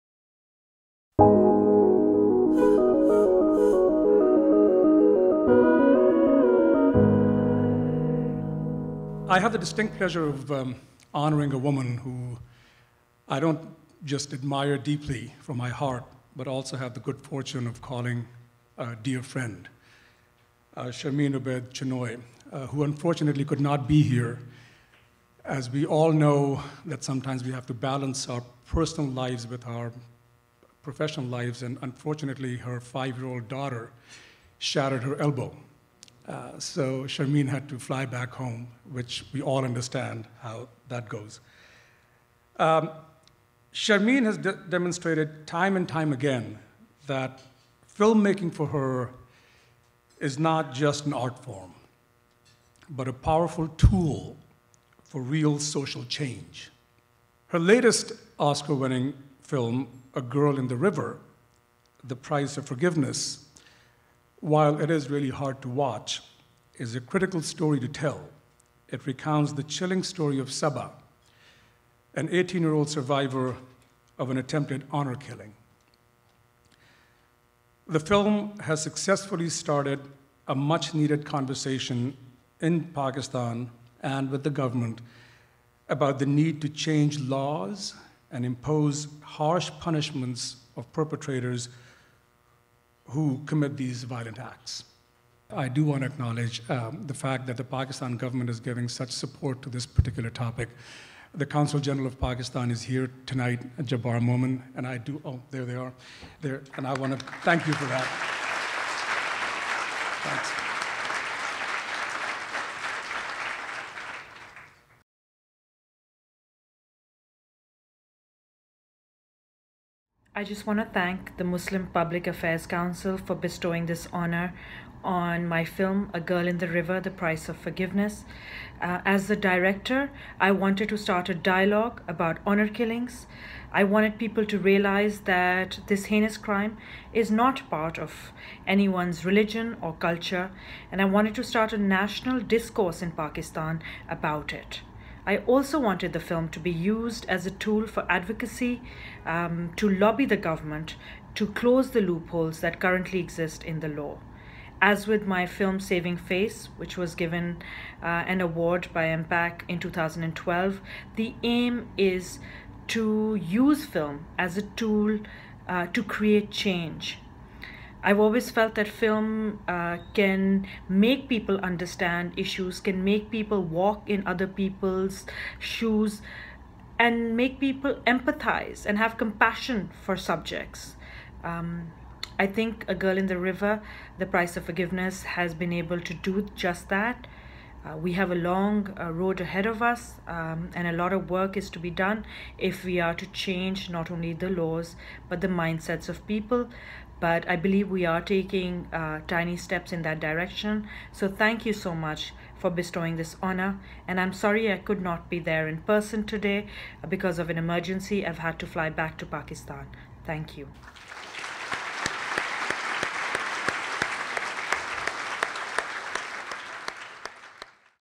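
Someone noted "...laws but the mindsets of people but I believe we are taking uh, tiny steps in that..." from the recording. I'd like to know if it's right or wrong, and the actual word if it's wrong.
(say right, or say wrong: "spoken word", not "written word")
right.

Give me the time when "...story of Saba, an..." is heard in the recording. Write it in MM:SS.
01:10.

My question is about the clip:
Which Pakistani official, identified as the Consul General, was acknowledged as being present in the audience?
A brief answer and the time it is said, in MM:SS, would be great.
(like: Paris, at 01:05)
Jabbar Momin, at 01:43.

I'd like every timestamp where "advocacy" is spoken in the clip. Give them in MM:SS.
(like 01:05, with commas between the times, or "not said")
02:28.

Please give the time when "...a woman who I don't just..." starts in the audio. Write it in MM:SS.
00:11.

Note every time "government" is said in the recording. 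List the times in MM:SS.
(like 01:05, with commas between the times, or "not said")
01:24, 01:38, 02:30.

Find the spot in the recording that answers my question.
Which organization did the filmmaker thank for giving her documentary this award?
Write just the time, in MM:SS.
02:01.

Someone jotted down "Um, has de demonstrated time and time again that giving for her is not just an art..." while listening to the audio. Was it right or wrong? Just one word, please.
wrong.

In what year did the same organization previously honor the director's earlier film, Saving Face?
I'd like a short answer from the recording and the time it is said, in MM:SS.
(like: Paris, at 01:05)
2012, at 02:39.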